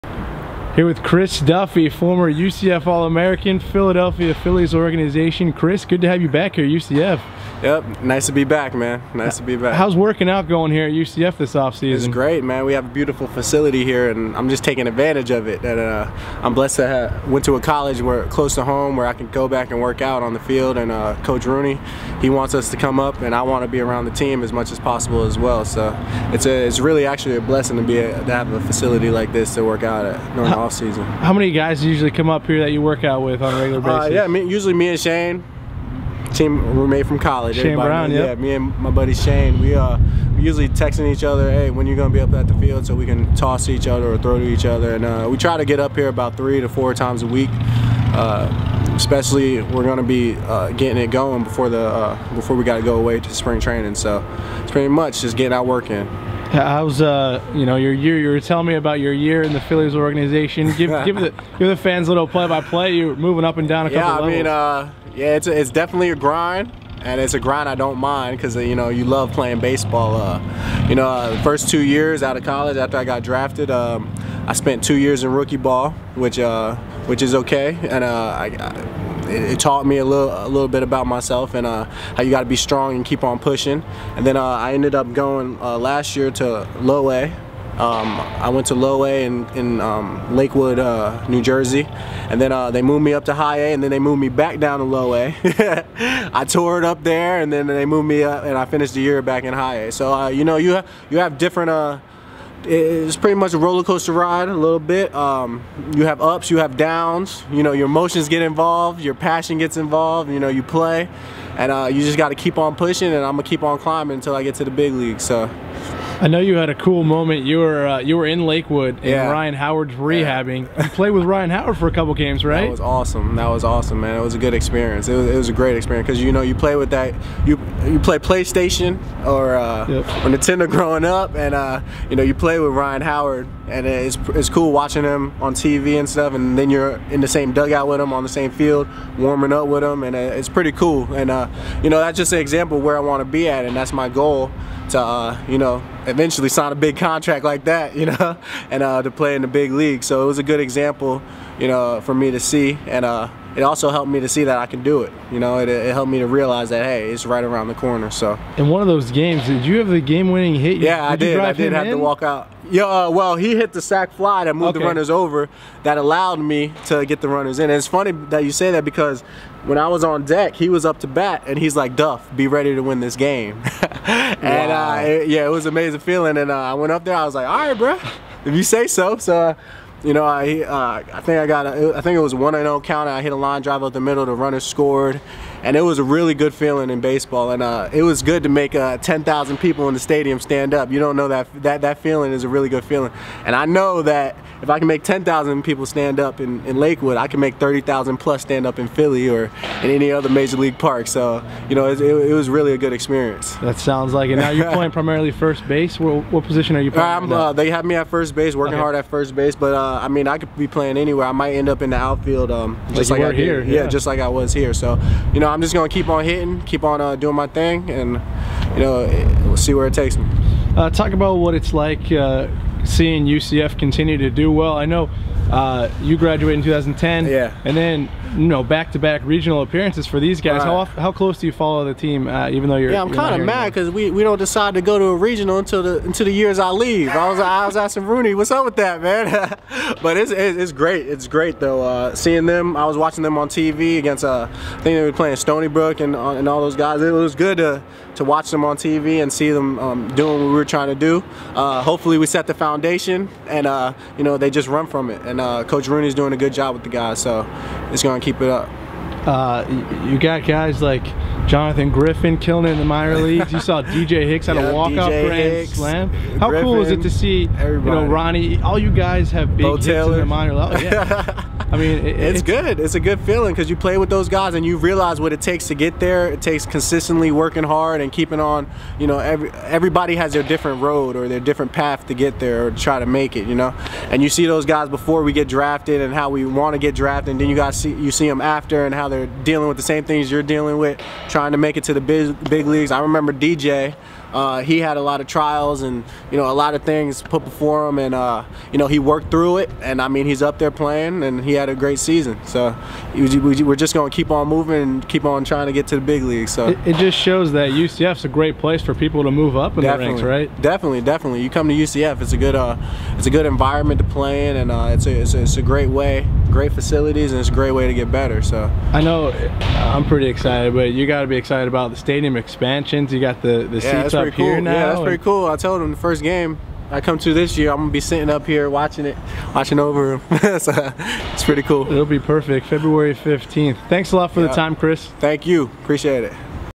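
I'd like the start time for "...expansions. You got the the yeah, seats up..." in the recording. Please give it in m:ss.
5:22.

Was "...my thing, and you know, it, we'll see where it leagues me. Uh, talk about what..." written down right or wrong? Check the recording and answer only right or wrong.
wrong.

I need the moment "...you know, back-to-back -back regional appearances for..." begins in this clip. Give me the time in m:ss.
3:48.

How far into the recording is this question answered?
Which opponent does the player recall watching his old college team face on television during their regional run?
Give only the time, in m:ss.
4:05.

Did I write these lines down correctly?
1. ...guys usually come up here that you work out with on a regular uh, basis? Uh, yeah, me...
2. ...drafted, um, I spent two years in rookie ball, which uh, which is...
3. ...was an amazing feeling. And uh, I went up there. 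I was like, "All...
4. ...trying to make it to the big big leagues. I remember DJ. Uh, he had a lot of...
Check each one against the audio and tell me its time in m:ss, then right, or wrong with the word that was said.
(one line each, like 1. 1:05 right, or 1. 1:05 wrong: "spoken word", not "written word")
1. 0:31 right
2. 1:13 right
3. 2:55 right
4. 4:51 right.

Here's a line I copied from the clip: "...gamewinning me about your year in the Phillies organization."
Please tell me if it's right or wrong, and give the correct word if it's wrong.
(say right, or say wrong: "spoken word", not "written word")
wrong: "telling", not "gamewinning".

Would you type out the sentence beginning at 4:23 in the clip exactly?
You saw DJ Hicks had yeah, a walk-off grand slam.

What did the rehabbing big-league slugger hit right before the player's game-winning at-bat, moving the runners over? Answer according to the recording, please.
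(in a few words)
Sac fly.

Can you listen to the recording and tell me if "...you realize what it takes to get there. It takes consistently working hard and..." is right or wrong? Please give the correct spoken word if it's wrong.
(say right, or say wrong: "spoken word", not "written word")
right.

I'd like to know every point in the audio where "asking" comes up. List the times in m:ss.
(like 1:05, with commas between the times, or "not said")
3:57.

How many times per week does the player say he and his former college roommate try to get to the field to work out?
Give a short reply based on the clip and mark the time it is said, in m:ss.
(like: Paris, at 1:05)
3 to 4, at 0:46.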